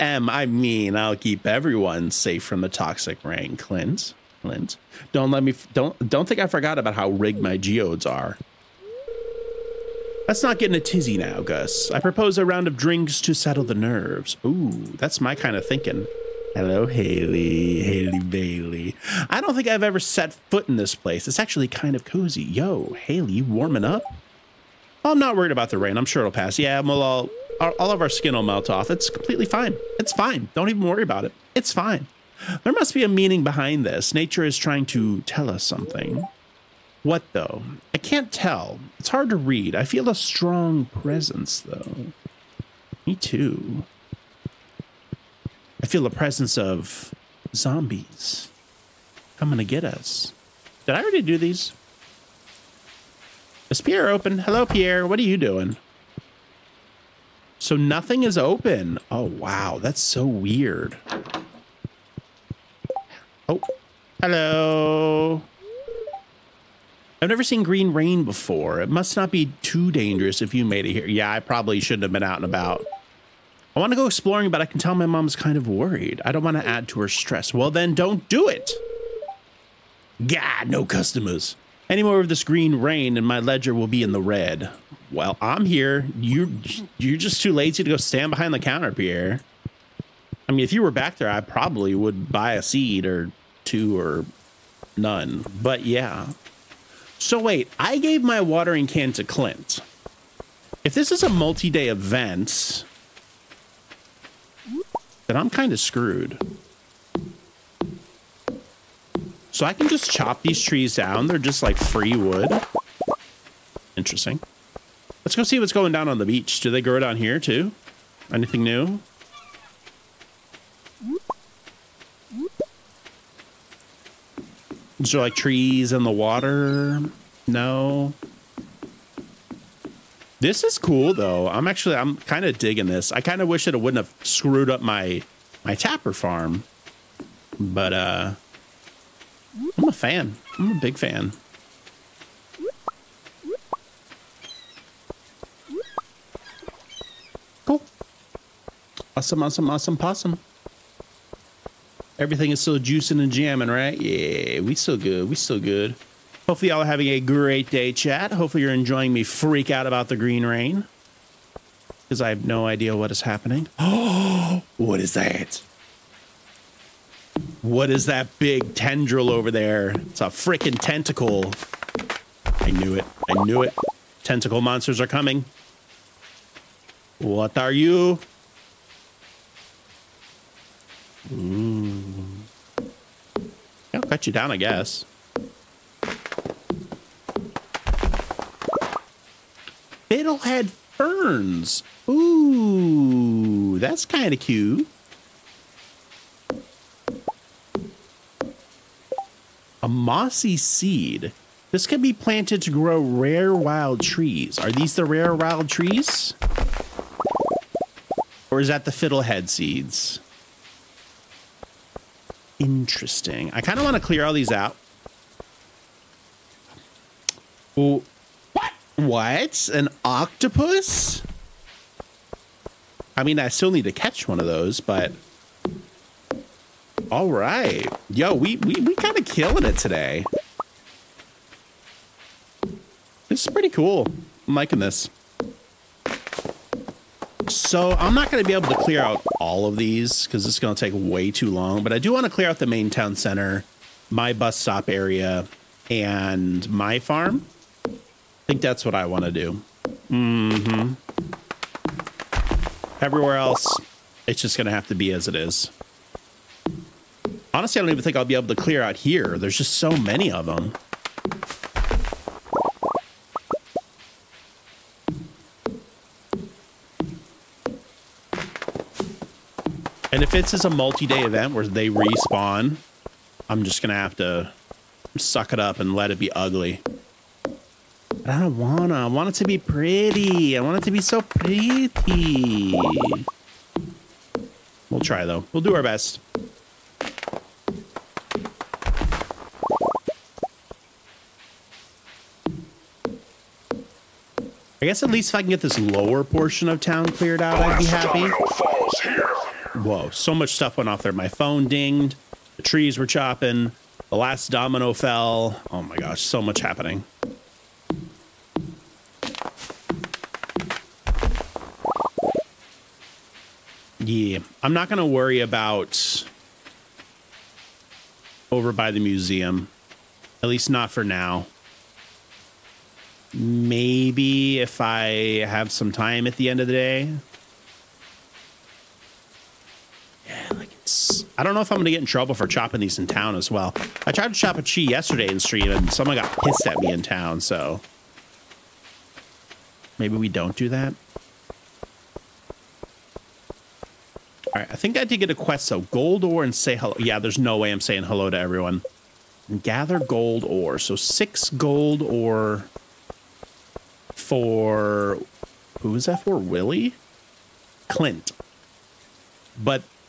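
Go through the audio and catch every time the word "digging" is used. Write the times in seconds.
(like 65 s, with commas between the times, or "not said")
132 s.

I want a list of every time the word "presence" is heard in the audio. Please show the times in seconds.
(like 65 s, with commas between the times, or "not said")
40 s, 46 s.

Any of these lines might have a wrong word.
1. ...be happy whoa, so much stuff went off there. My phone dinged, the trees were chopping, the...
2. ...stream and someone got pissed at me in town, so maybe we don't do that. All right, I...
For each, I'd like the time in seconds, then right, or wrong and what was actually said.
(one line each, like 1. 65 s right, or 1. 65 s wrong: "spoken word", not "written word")
1. 297 s right
2. 335 s right.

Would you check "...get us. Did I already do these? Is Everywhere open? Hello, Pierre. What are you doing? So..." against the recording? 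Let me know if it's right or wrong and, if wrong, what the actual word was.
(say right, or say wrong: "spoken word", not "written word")
wrong: "Pierre", not "Everywhere".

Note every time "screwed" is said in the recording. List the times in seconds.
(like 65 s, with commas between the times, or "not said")
105 s, 134 s.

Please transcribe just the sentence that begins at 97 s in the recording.
So wait, I gave my watering can to Clint.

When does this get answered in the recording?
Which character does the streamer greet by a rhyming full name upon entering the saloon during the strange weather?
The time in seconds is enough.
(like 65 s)
17 s.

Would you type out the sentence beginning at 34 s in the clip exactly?
Nature is trying to tell us something.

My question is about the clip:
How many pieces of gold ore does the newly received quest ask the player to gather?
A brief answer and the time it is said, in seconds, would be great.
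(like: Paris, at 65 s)
6, at 350 s.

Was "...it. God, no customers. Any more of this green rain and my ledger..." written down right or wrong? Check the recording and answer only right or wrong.
right.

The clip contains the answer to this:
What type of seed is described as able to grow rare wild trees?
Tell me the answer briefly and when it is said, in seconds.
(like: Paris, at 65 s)
mossy seed, at 199 s.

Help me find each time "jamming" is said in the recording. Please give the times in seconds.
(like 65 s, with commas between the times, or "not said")
153 s.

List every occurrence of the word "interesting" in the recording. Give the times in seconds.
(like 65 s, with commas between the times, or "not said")
113 s, 212 s.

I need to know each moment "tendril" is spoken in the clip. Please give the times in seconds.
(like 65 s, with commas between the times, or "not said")
168 s.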